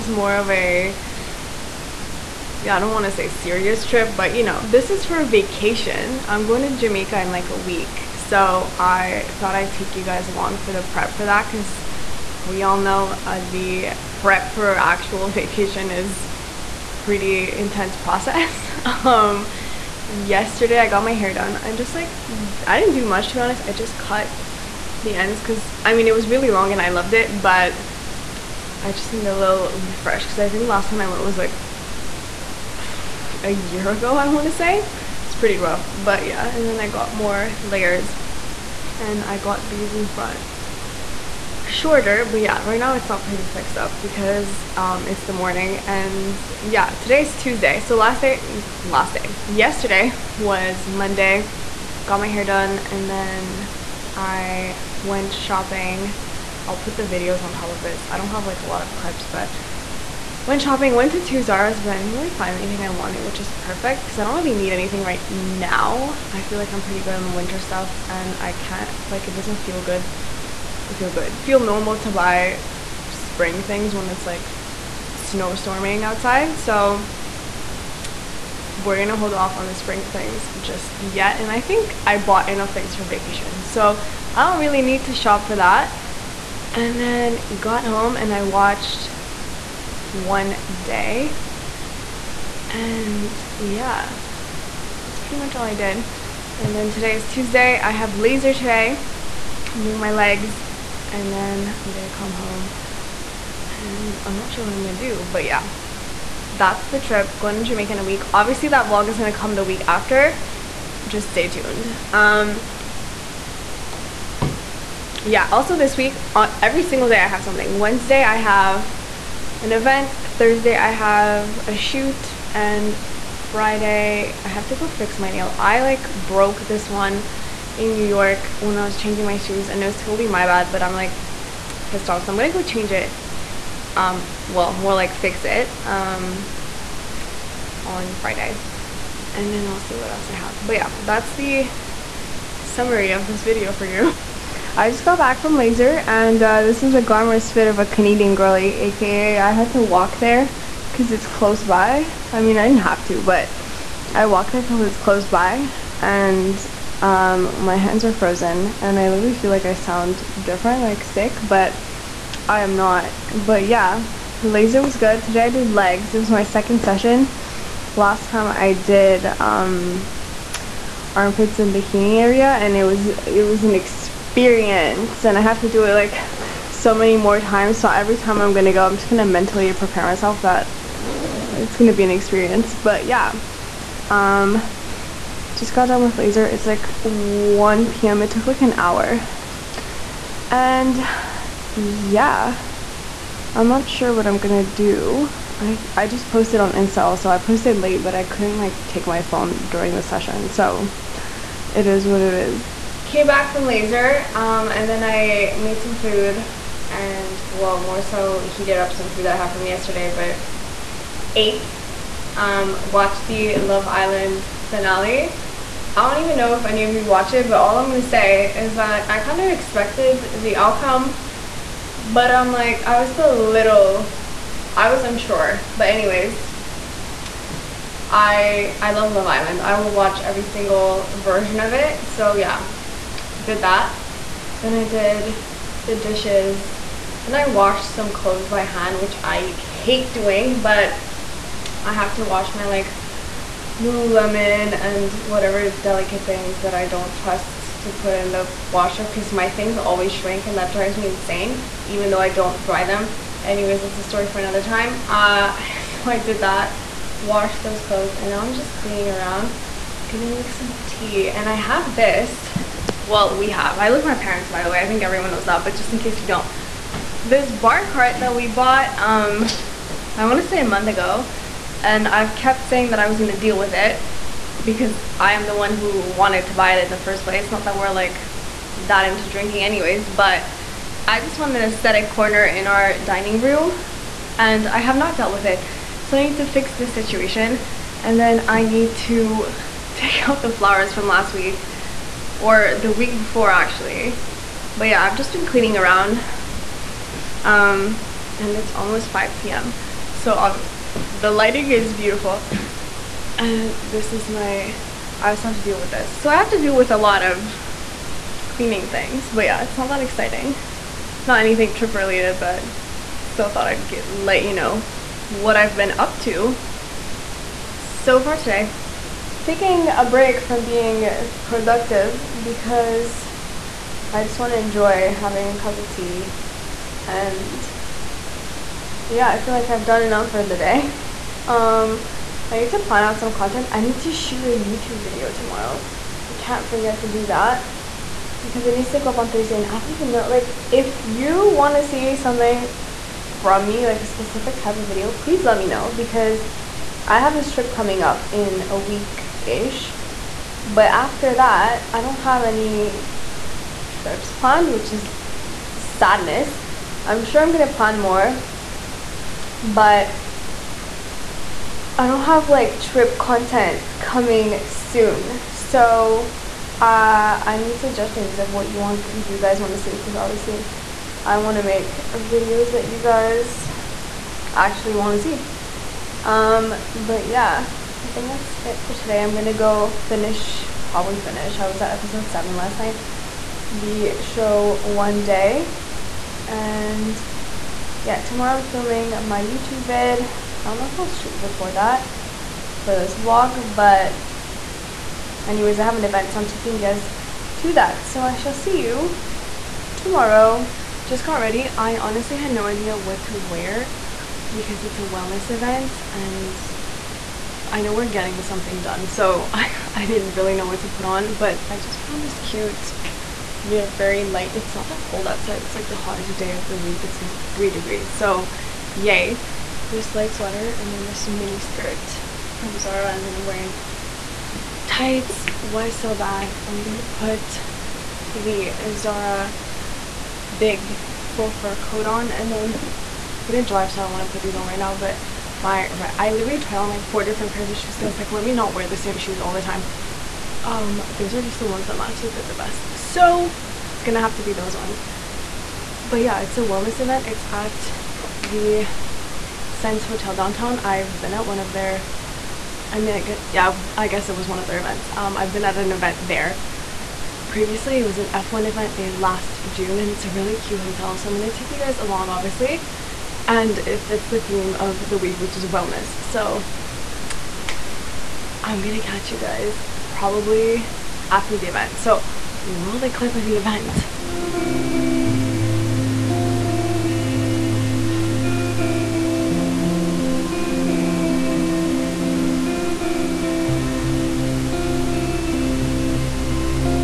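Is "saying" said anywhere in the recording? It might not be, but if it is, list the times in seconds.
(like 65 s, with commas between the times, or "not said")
272 s.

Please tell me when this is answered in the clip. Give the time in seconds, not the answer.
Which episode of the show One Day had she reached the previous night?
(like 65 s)
381 s.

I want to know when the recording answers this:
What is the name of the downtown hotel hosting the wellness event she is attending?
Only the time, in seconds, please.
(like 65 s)
449 s.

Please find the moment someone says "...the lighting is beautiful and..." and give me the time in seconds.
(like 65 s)
301 s.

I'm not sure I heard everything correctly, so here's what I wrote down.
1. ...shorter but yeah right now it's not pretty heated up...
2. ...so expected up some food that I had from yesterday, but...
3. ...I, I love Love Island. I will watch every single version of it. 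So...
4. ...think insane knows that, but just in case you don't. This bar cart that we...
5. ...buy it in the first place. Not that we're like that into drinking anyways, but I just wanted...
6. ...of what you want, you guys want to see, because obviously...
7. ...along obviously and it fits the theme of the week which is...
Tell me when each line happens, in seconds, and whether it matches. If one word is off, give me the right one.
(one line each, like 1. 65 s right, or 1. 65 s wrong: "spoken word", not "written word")
1. 41 s wrong: "fixed", not "heated"
2. 207 s wrong: "heated", not "expected"
3. 228 s right
4. 264 s wrong: "everyone", not "insane"
5. 276 s right
6. 368 s right
7. 461 s right.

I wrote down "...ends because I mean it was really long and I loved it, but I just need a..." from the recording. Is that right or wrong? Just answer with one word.
right.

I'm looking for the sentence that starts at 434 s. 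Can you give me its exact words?
But my I literally tried on like four different pairs of shoes.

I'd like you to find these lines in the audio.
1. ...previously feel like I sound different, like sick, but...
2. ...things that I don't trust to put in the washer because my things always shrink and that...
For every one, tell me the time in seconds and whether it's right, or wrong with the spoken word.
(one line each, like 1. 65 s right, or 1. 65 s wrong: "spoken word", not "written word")
1. 159 s wrong: "literally", not "previously"
2. 246 s right.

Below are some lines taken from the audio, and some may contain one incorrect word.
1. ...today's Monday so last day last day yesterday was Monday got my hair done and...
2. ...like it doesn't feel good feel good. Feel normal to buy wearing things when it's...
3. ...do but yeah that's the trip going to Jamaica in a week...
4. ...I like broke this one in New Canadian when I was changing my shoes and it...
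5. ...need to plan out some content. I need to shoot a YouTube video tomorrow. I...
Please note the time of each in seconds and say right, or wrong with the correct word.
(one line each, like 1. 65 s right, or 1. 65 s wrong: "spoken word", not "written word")
1. 46 s wrong: "Tuesday", not "Monday"
2. 69 s wrong: "spring", not "wearing"
3. 104 s right
4. 125 s wrong: "York", not "Canadian"
5. 332 s right.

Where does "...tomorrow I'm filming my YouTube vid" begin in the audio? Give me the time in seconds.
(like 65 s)
388 s.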